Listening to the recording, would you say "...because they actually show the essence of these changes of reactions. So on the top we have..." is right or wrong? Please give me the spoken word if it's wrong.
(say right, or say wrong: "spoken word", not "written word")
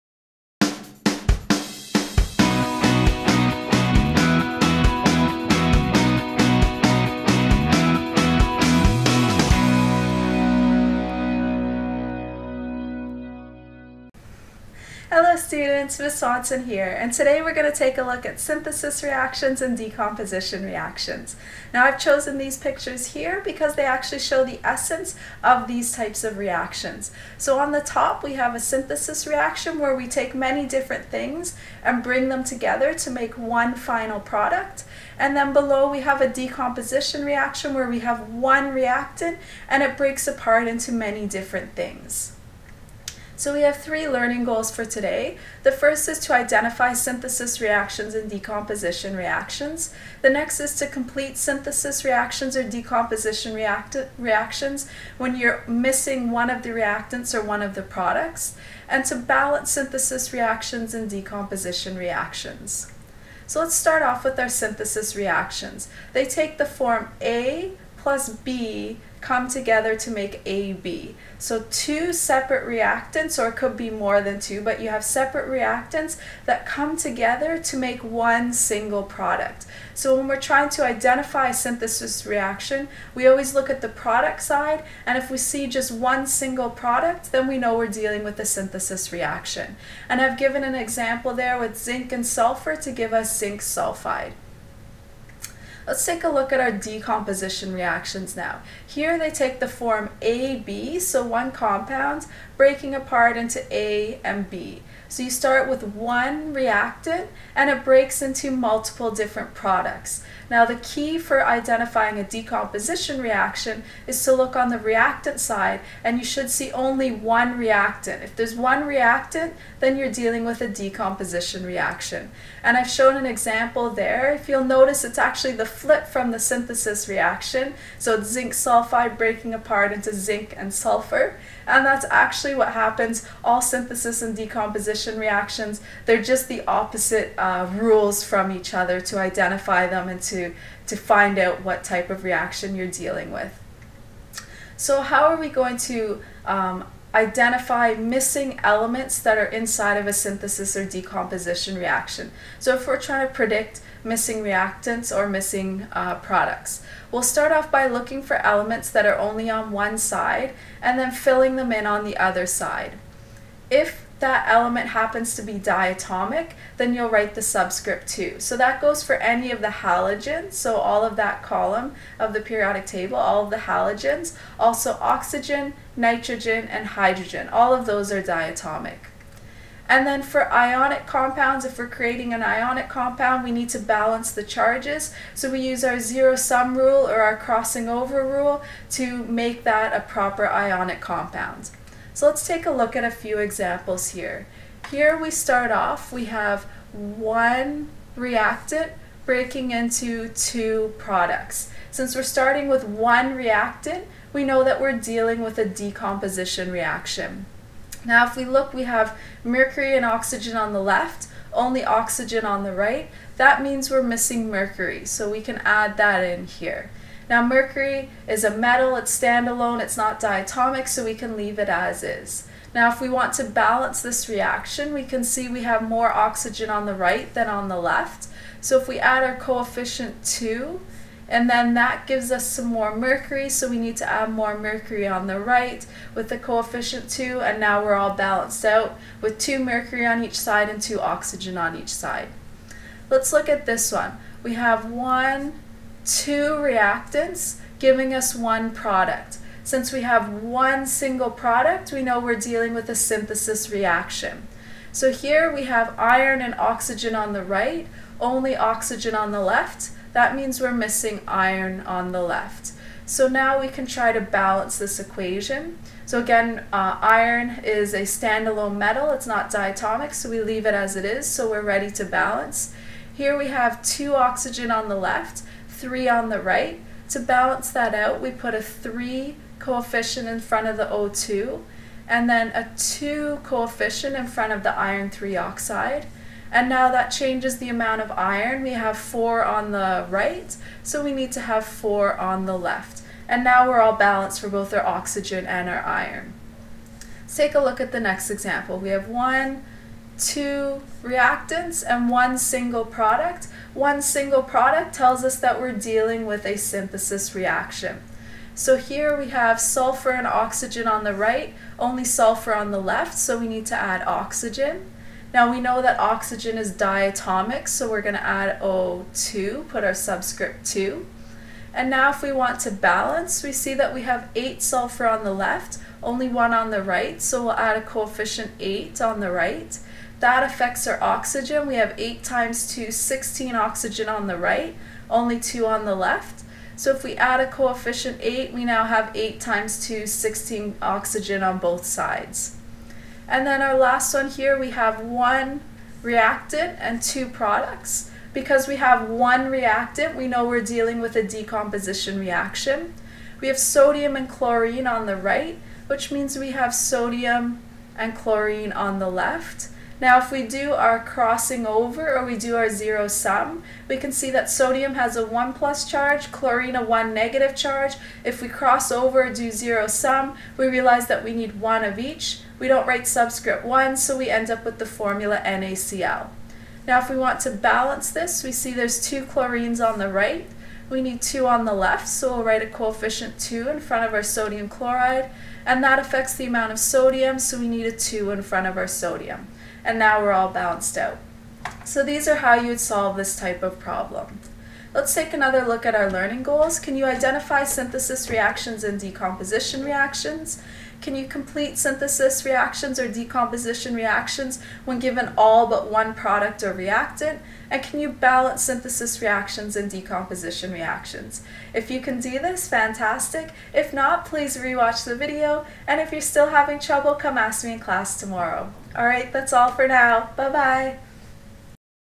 wrong: "types", not "changes".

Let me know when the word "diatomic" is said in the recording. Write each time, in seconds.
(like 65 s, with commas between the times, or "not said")
165 s, 178 s, 220 s, 269 s, 316 s.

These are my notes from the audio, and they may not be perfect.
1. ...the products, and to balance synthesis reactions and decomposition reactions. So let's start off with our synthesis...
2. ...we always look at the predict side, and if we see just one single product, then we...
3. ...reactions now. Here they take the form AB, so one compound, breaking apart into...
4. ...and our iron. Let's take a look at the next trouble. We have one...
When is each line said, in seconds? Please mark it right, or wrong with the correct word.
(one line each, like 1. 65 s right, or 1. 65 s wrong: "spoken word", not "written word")
1. 57 s right
2. 83 s wrong: "product", not "predict"
3. 97 s right
4. 295 s wrong: "example", not "trouble".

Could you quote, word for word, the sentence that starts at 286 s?
And now that changes the amount of iron.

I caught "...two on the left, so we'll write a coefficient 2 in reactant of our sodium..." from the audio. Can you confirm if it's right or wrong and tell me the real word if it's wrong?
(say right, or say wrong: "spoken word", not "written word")
wrong: "front", not "reactant".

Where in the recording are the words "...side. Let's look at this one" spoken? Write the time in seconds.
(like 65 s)
241 s.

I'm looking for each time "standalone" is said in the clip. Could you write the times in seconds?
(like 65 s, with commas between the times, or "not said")
219 s, 268 s.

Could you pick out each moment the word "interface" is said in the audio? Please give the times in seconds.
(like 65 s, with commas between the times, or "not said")
not said.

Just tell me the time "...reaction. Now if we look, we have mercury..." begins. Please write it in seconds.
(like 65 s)
206 s.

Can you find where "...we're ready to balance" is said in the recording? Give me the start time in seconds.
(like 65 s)
271 s.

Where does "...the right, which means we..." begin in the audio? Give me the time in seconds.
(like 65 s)
355 s.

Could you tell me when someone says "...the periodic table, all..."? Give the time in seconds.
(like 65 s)
172 s.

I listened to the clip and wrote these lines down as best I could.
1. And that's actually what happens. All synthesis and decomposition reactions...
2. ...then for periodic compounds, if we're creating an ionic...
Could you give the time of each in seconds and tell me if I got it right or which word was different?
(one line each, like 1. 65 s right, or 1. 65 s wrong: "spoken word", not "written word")
1. 131 s right
2. 180 s wrong: "ionic", not "periodic".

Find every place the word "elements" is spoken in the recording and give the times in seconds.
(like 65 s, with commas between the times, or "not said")
148 s, 158 s, 164 s.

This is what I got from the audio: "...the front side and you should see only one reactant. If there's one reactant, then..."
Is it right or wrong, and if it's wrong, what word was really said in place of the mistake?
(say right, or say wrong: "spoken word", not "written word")
wrong: "reactant", not "front".